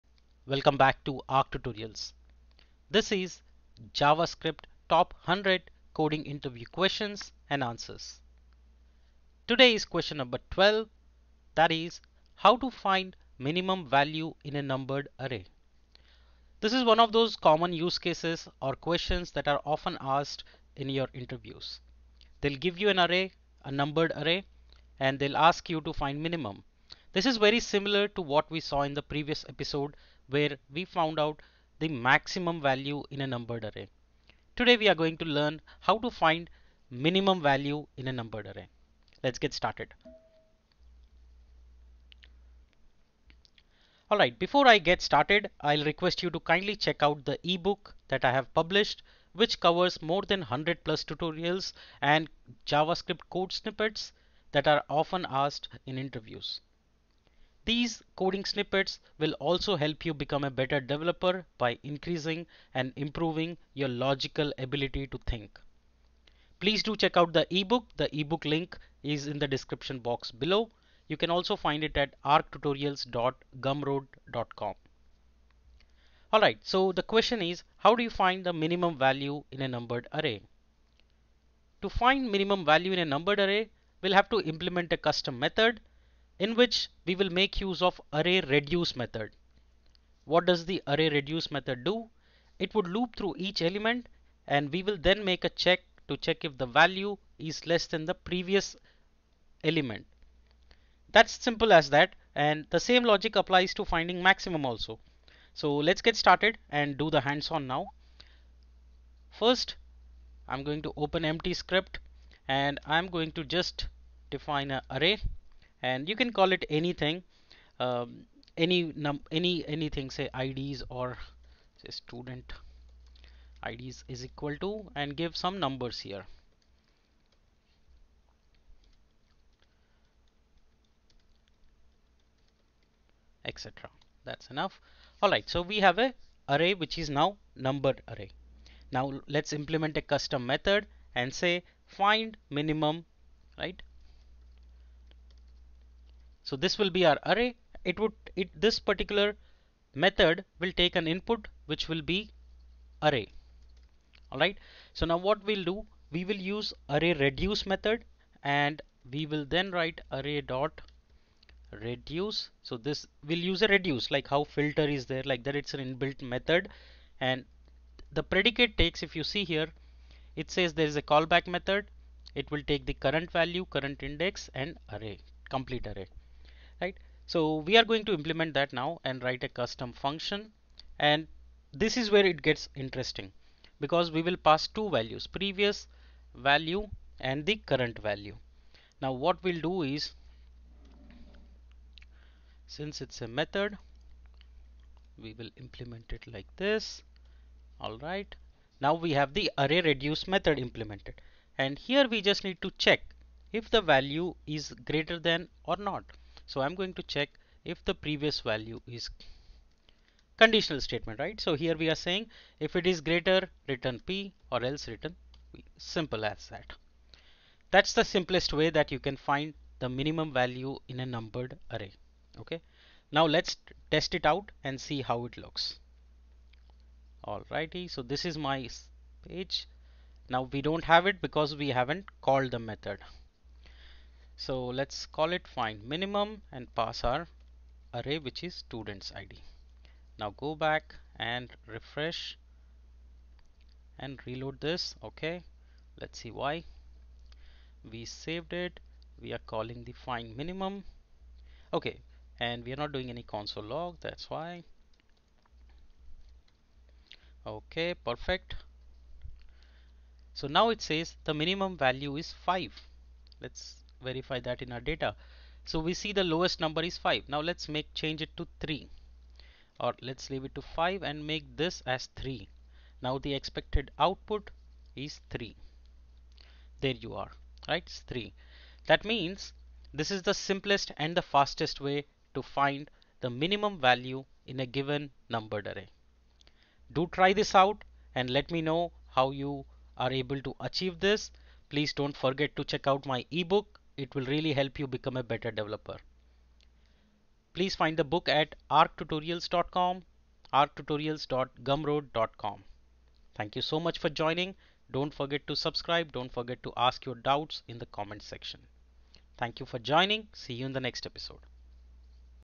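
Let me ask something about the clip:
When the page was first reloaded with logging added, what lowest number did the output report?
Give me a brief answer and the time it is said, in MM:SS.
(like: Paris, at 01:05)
5, at 04:21.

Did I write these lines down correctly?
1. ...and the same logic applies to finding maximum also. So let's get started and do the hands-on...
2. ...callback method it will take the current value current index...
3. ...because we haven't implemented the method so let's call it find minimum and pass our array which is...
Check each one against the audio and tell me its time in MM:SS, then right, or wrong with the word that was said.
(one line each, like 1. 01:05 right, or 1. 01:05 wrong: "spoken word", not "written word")
1. 01:42 right
2. 02:51 right
3. 03:51 wrong: "called", not "implemented".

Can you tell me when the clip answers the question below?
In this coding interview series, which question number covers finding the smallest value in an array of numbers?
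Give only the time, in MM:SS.
00:09.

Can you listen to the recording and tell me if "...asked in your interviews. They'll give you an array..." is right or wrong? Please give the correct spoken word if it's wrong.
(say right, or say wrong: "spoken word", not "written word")
right.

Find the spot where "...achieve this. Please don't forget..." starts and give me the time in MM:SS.
04:50.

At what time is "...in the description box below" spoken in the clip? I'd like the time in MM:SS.
01:09.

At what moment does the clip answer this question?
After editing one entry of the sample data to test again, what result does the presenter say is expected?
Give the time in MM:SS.
04:33.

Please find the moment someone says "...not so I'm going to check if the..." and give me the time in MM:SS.
03:25.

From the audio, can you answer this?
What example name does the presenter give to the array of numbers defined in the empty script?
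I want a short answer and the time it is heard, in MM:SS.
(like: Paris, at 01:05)
student IDs, at 02:01.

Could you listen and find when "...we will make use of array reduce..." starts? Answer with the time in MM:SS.
01:27.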